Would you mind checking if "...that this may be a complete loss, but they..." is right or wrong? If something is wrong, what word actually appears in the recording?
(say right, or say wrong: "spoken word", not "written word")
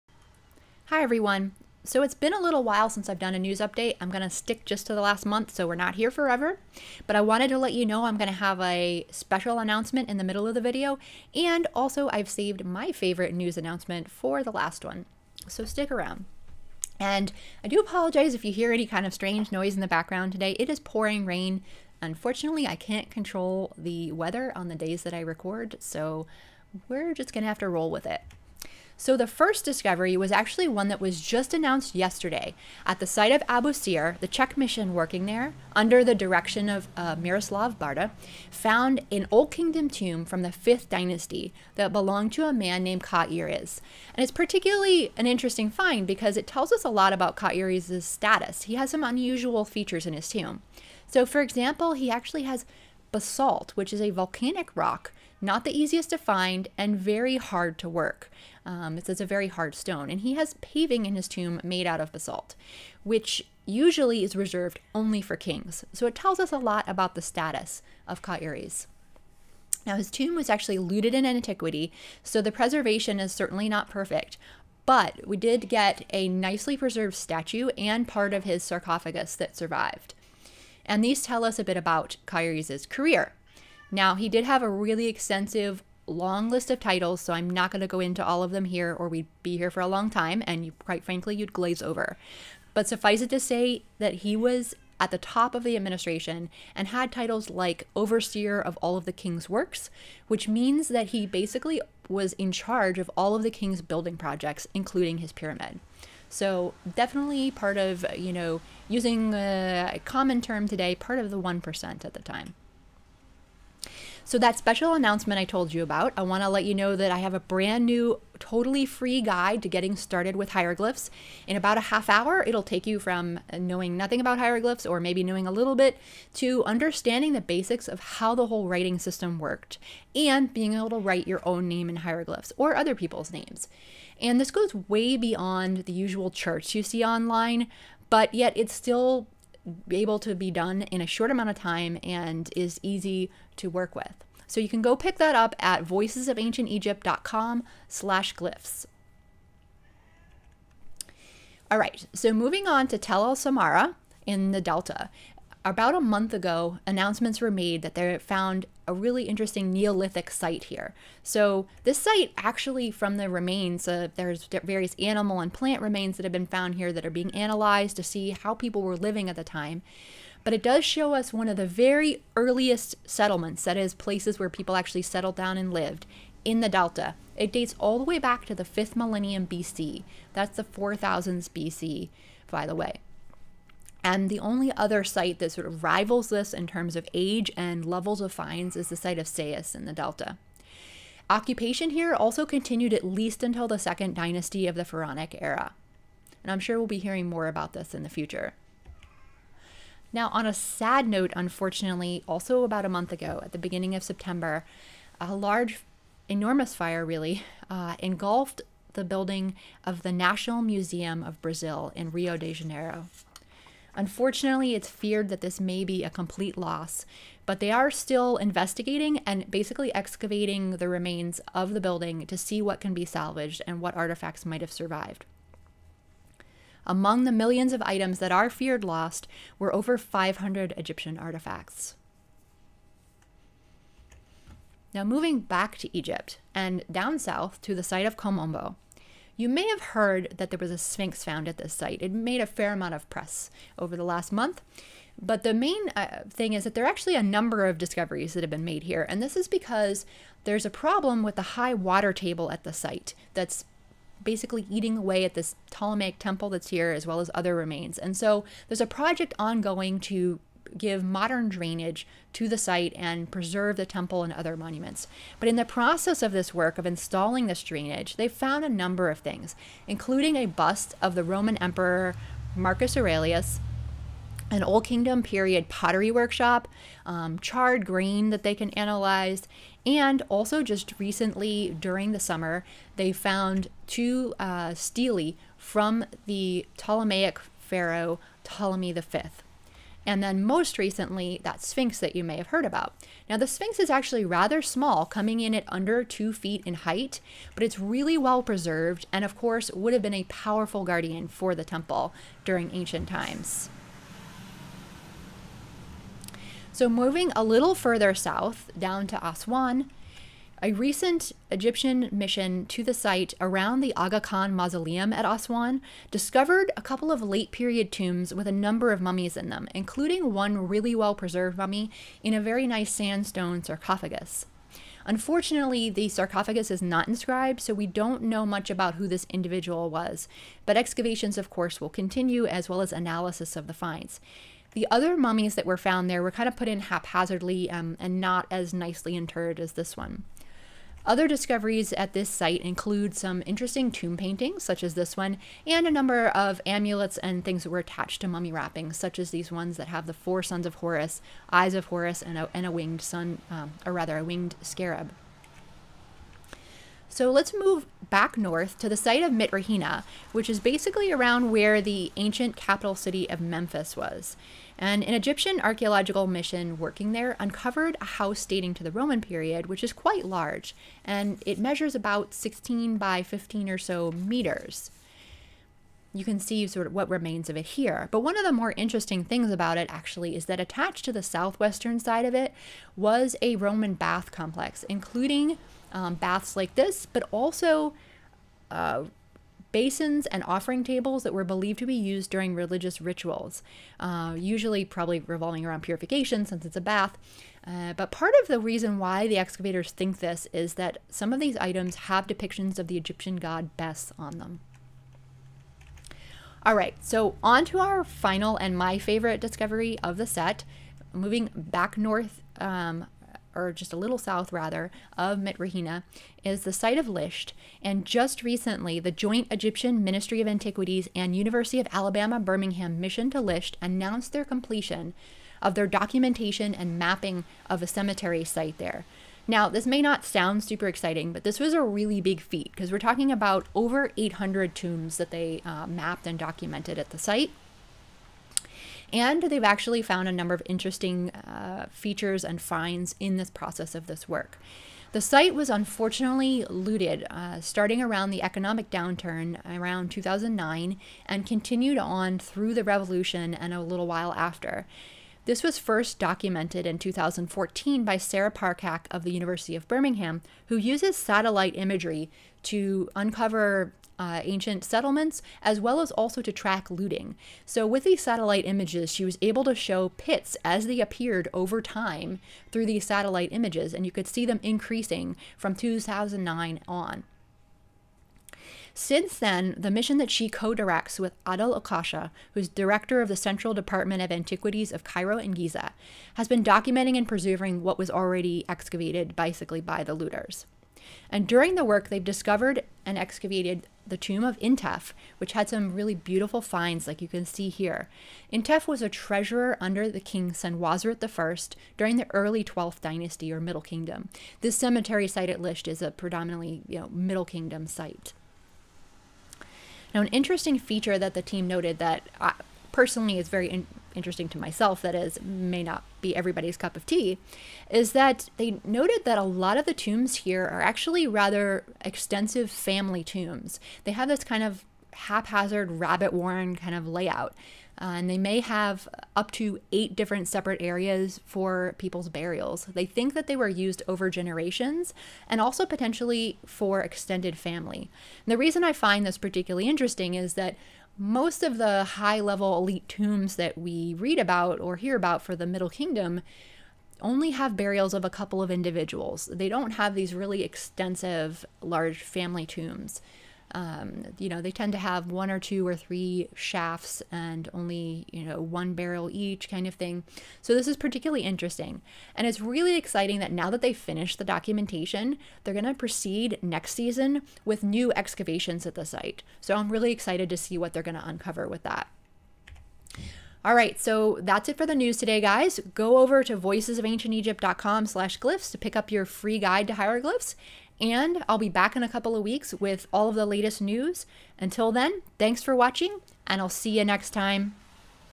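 right.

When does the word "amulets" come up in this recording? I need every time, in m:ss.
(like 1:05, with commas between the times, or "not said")
5:46.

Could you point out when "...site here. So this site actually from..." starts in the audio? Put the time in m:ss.
2:40.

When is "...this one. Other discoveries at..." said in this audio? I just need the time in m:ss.
5:39.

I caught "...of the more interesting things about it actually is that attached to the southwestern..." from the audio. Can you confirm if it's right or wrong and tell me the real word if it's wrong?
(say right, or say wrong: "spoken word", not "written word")
right.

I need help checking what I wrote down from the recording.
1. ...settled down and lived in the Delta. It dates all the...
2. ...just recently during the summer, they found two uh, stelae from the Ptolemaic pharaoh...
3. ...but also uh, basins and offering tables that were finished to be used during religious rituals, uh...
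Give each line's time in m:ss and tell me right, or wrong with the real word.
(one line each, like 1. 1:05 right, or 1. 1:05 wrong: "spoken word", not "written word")
1. 2:55 right
2. 4:40 right
3. 6:27 wrong: "believed", not "finished".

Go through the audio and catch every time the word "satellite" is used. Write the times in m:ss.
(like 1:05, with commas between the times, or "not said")
7:41, 7:48, 7:53.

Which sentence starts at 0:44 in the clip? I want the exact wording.
And it's particularly an interesting find because it tells us a lot about Kaires's status.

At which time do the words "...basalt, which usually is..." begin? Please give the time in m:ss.
1:02.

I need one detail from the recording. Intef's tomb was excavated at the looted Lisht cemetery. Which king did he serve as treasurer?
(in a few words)
Senwosret I.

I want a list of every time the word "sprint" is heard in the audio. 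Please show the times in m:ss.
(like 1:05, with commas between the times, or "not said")
not said.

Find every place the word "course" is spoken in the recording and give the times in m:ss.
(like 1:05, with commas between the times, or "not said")
4:59, 5:31.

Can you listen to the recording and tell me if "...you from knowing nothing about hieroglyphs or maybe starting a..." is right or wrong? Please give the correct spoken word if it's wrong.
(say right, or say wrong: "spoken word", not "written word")
wrong: "knowing", not "starting".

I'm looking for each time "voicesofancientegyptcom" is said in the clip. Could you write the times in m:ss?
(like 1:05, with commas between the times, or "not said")
2:25, 9:36.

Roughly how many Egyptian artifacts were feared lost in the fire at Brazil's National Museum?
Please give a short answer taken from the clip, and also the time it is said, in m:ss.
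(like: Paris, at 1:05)
Over 500, at 3:49.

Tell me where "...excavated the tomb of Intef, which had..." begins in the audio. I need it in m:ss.
8:13.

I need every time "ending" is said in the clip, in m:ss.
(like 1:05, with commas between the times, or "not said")
not said.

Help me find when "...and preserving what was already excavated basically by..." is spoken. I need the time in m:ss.
8:07.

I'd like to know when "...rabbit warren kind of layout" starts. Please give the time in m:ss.
8:45.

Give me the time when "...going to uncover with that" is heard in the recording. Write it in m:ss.
9:31.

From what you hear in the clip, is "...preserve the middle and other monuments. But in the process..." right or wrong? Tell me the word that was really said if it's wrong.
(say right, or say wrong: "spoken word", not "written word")
wrong: "temple", not "middle".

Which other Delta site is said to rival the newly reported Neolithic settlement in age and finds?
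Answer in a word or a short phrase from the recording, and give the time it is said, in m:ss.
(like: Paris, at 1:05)
Sais, at 3:09.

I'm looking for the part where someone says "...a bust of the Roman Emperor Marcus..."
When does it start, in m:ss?
4:30.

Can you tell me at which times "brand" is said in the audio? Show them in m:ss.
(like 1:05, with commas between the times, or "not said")
1:57.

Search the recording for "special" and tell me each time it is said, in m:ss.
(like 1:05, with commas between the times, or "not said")
0:09, 1:54.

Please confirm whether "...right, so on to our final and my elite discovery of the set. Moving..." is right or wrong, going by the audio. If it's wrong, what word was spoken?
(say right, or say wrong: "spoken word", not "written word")
wrong: "favorite", not "elite".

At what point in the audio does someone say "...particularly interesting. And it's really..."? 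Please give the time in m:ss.
9:20.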